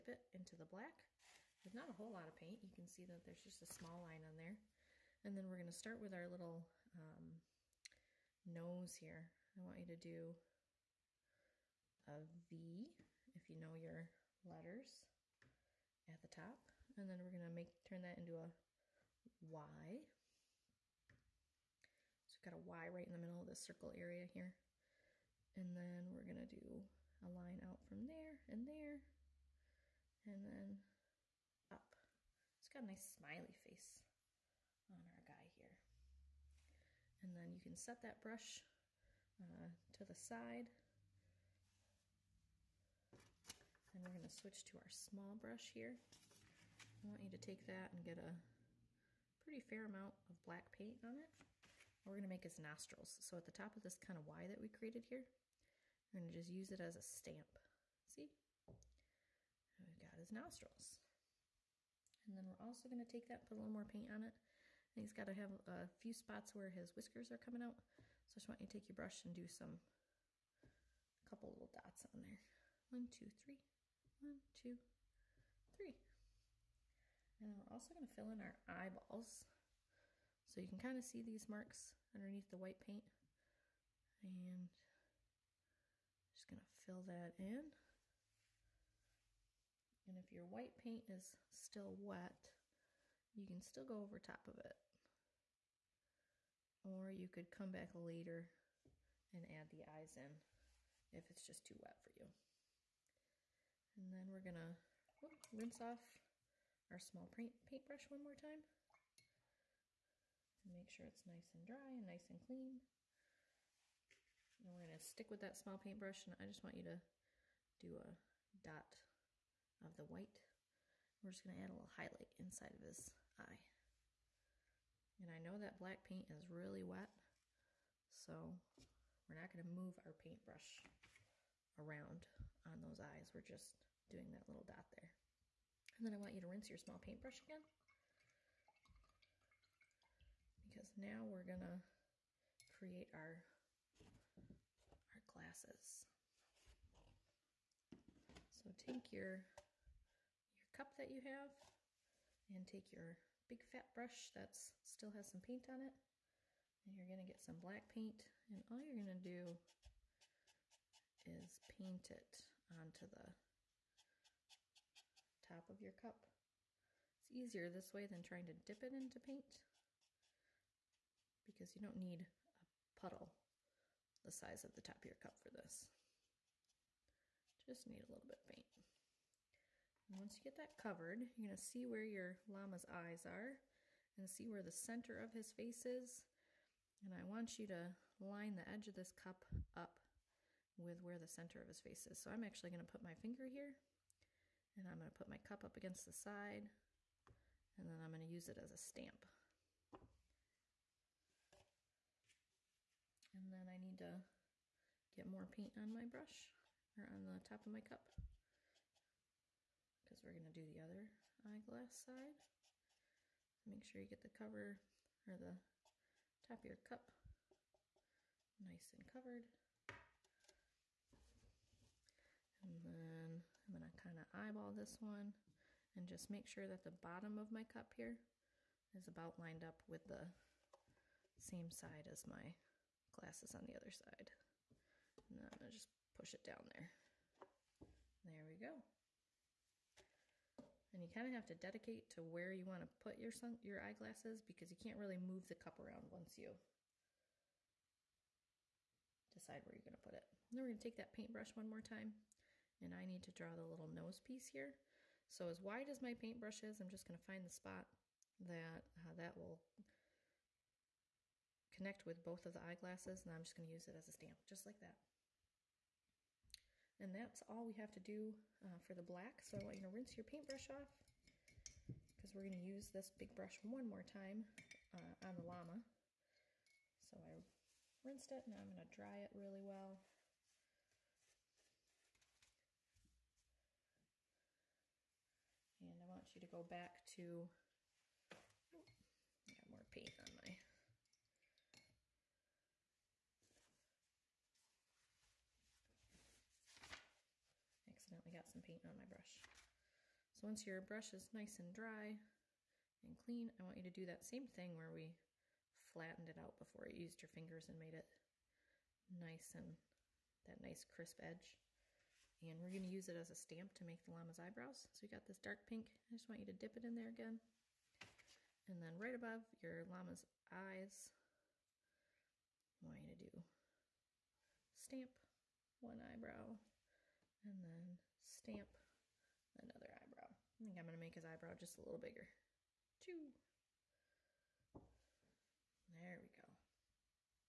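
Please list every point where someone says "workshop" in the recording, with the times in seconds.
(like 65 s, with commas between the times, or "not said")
not said.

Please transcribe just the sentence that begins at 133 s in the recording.
We're just doing that little dot there.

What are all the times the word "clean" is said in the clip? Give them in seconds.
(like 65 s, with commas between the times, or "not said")
112 s, 303 s.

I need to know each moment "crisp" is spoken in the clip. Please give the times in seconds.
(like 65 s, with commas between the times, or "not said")
310 s.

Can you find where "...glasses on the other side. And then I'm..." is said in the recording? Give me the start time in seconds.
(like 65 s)
233 s.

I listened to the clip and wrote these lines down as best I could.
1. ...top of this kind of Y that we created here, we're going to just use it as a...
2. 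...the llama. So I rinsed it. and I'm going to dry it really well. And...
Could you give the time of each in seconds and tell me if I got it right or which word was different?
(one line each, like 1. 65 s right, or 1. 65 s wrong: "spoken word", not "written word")
1. 53 s right
2. 275 s right.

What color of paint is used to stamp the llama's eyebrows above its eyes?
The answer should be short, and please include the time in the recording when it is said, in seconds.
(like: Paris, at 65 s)
dark pink, at 315 s.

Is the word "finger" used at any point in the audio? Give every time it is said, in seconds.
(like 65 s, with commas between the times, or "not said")
193 s, 307 s.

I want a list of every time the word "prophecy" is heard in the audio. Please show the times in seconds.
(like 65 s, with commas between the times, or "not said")
not said.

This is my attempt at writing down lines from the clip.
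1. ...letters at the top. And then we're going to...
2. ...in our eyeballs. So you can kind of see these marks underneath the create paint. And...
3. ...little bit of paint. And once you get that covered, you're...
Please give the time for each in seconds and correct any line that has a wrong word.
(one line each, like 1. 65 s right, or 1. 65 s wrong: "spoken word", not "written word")
1. 14 s right
2. 78 s wrong: "white", not "create"
3. 178 s right.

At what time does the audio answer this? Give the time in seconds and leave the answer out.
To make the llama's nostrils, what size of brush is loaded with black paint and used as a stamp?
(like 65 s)
44 s.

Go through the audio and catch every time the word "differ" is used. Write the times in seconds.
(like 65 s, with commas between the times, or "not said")
not said.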